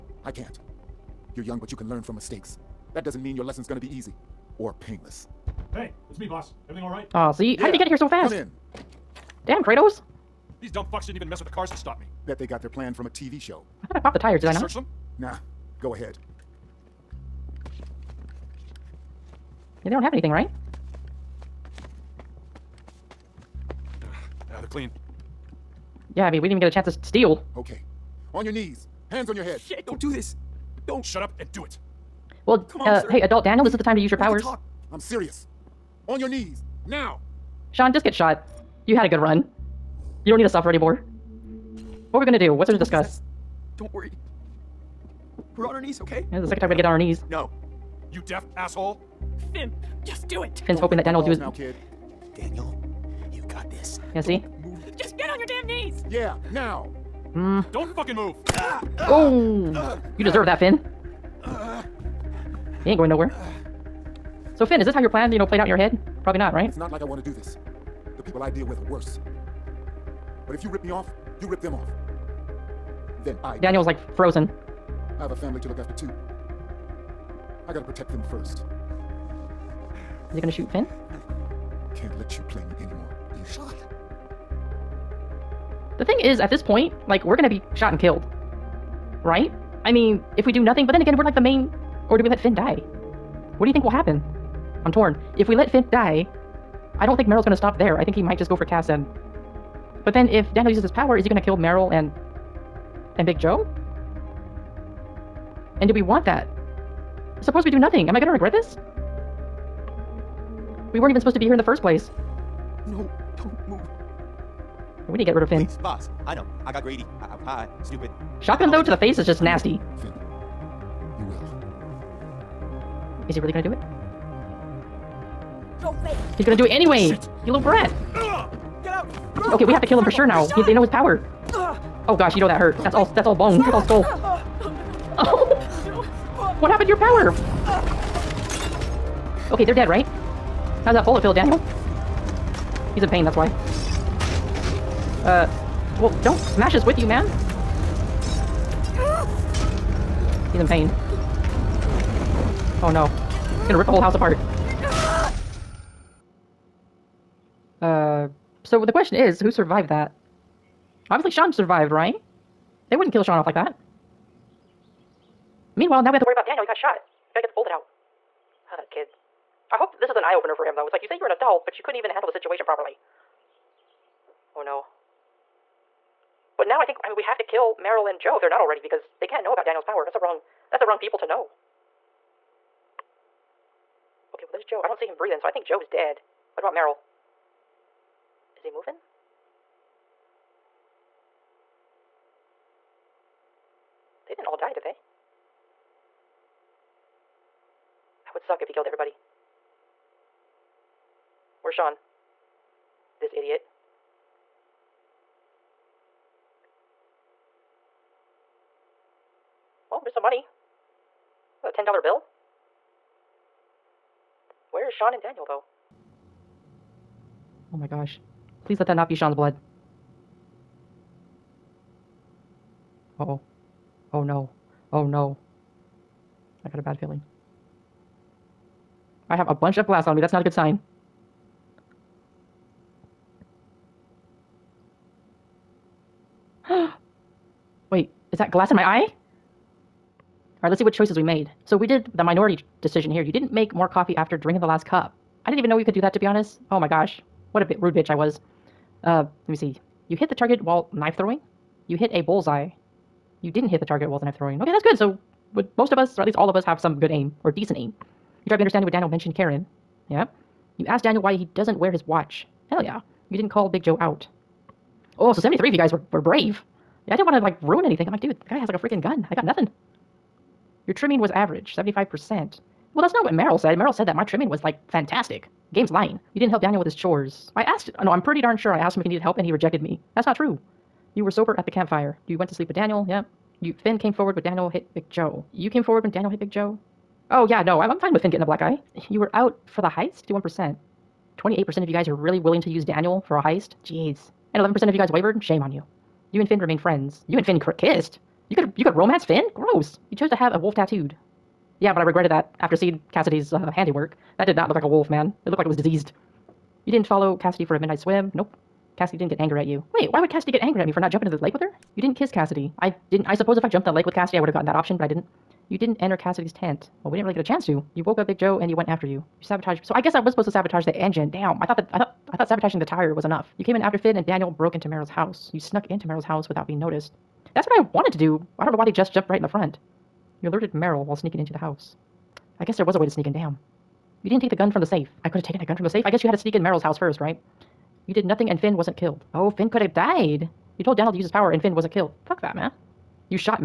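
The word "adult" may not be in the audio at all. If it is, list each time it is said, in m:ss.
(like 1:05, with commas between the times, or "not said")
0:33, 2:51.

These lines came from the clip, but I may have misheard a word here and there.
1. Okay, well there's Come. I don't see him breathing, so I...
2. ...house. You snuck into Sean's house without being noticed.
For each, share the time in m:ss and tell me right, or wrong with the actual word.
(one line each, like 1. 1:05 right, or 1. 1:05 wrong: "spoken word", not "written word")
1. 3:04 wrong: "Joe", not "Come"
2. 5:25 wrong: "Merrill", not "Sean".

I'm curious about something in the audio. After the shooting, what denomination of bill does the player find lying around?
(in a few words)
$10 bill.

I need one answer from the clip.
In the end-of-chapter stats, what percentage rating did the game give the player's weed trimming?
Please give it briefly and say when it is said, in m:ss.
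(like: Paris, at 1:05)
75%, at 4:31.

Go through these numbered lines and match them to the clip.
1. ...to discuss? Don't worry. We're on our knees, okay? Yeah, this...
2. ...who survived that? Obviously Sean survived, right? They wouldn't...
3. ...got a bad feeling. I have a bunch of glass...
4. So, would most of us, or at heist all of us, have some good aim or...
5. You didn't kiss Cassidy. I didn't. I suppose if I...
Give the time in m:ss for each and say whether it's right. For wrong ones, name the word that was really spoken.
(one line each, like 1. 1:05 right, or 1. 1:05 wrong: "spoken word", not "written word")
1. 0:42 right
2. 2:39 right
3. 3:46 right
4. 4:14 wrong: "least", not "heist"
5. 5:11 right.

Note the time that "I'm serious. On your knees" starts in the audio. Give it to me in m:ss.
0:34.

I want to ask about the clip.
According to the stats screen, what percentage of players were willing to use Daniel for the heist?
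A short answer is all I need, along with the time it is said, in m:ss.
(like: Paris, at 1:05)
28%, at 4:51.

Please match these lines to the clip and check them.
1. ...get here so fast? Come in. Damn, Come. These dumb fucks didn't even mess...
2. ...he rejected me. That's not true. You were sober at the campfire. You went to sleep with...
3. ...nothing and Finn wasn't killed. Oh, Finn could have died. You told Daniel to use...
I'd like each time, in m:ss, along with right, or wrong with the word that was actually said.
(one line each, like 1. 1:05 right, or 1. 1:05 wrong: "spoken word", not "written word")
1. 0:07 wrong: "Kratos", not "Come"
2. 4:39 right
3. 5:38 right.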